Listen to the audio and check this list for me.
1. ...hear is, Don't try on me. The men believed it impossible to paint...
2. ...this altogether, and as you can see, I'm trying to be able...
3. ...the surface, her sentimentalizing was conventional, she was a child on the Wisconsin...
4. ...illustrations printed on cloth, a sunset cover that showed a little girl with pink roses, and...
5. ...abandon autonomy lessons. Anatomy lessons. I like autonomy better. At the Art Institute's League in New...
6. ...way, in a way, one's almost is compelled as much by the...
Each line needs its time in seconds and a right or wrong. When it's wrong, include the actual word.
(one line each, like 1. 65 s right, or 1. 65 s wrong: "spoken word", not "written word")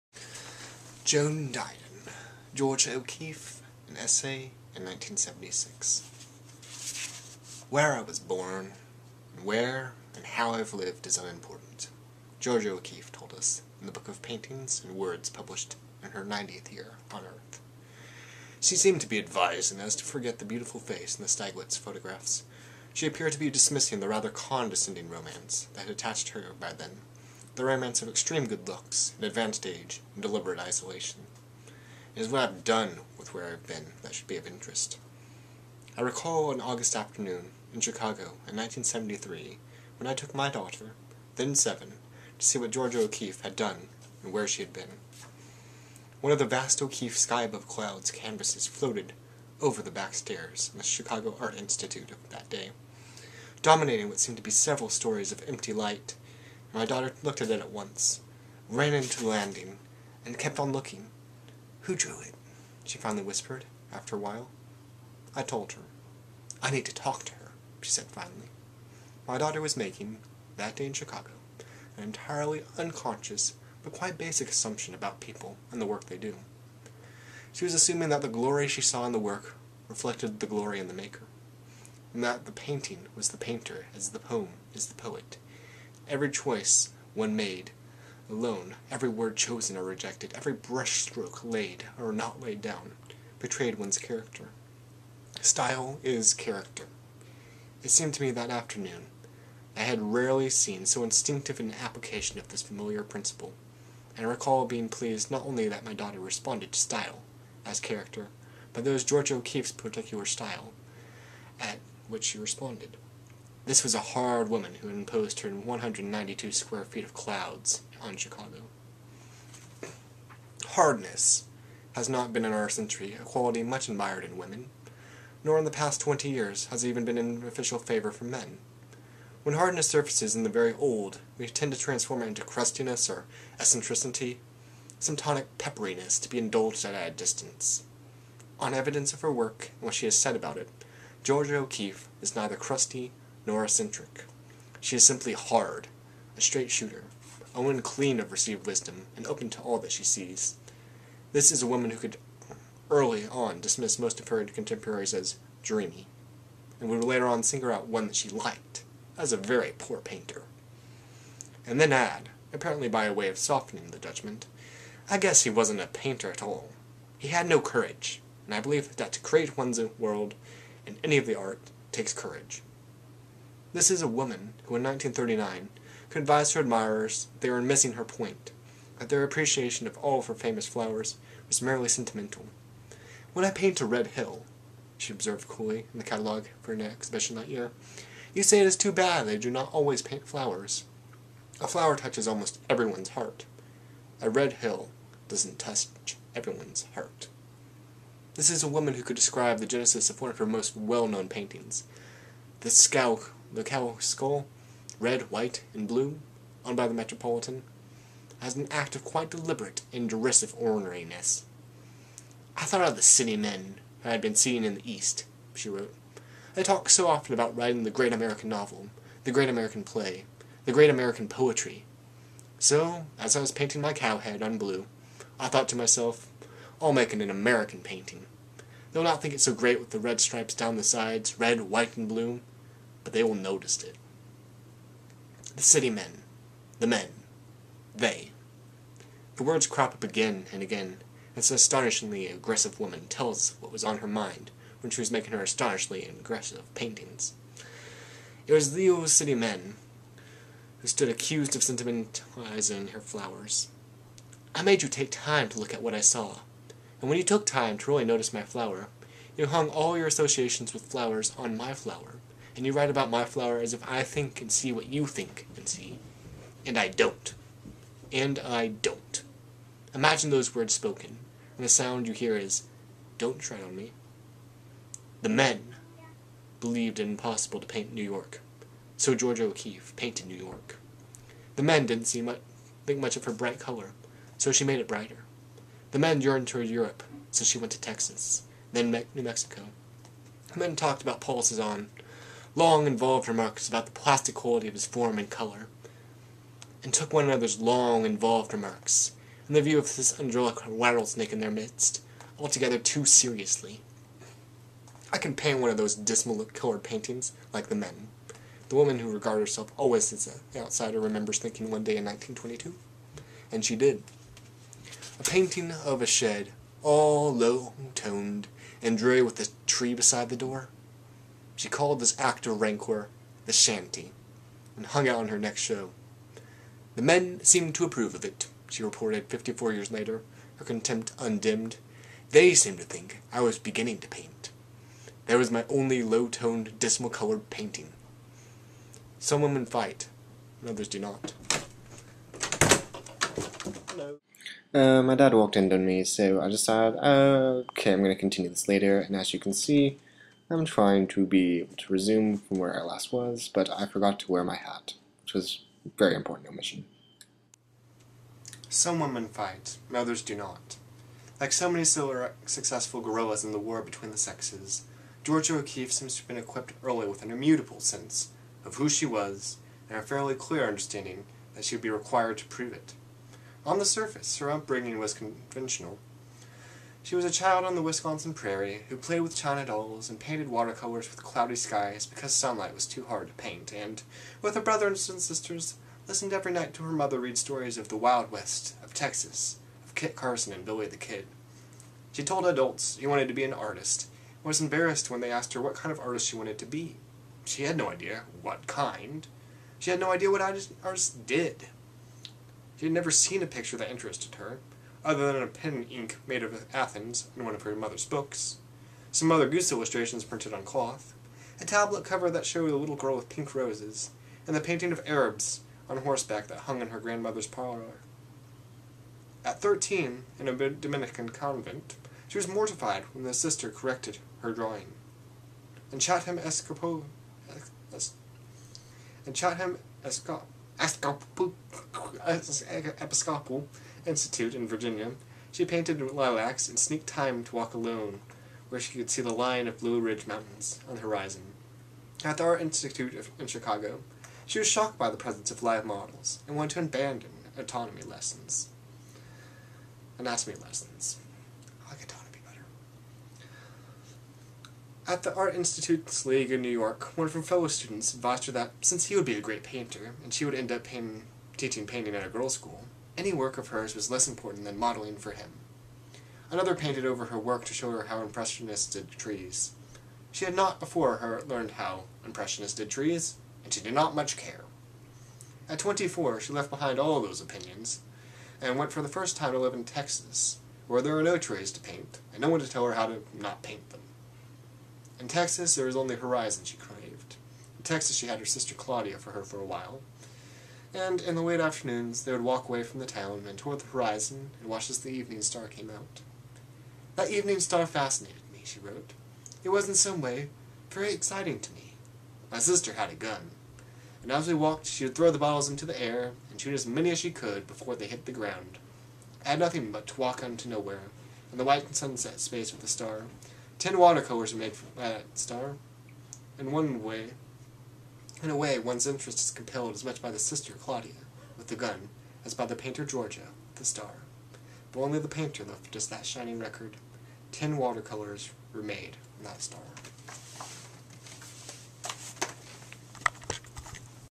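1. 272 s right
2. 348 s wrong: "later", not "altogether"
3. 373 s wrong: "upbringing", not "sentimentalizing"
4. 409 s wrong: "tablet", not "sunset"
5. 446 s right
6. 517 s wrong: "interest", not "almost".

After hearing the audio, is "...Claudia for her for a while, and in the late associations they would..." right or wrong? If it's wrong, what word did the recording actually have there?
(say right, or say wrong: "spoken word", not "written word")
wrong: "afternoons", not "associations".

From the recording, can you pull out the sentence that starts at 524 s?
But only the painter left just that shining record.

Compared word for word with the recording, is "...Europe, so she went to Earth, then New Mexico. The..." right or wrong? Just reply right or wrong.
wrong.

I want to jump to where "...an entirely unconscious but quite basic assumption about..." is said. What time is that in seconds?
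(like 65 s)
71 s.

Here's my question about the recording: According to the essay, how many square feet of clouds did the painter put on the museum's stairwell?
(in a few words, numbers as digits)
192.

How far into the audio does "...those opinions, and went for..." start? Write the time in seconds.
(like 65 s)
477 s.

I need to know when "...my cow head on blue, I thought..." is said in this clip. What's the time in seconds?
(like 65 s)
223 s.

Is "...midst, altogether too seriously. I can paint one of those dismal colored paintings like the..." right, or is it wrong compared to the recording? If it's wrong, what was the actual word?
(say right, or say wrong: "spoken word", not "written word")
right.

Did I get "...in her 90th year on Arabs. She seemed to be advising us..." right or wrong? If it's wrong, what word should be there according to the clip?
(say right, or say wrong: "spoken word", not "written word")
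wrong: "Earth", not "Arabs".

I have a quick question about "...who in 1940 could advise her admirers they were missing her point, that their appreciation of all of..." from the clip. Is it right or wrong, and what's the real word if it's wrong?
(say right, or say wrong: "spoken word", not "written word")
wrong: "1939", not "1940".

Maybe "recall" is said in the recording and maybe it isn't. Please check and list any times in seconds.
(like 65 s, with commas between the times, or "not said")
36 s, 104 s.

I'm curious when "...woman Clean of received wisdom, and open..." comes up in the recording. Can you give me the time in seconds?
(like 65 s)
147 s.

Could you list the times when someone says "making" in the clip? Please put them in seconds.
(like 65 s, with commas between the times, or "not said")
69 s, 245 s.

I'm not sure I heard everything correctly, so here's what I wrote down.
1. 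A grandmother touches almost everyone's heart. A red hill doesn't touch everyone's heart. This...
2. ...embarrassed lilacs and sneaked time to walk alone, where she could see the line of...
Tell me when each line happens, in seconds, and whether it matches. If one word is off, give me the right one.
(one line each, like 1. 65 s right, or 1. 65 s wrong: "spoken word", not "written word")
1. 191 s wrong: "flower", not "grandmother"
2. 435 s wrong: "painted", not "embarrassed".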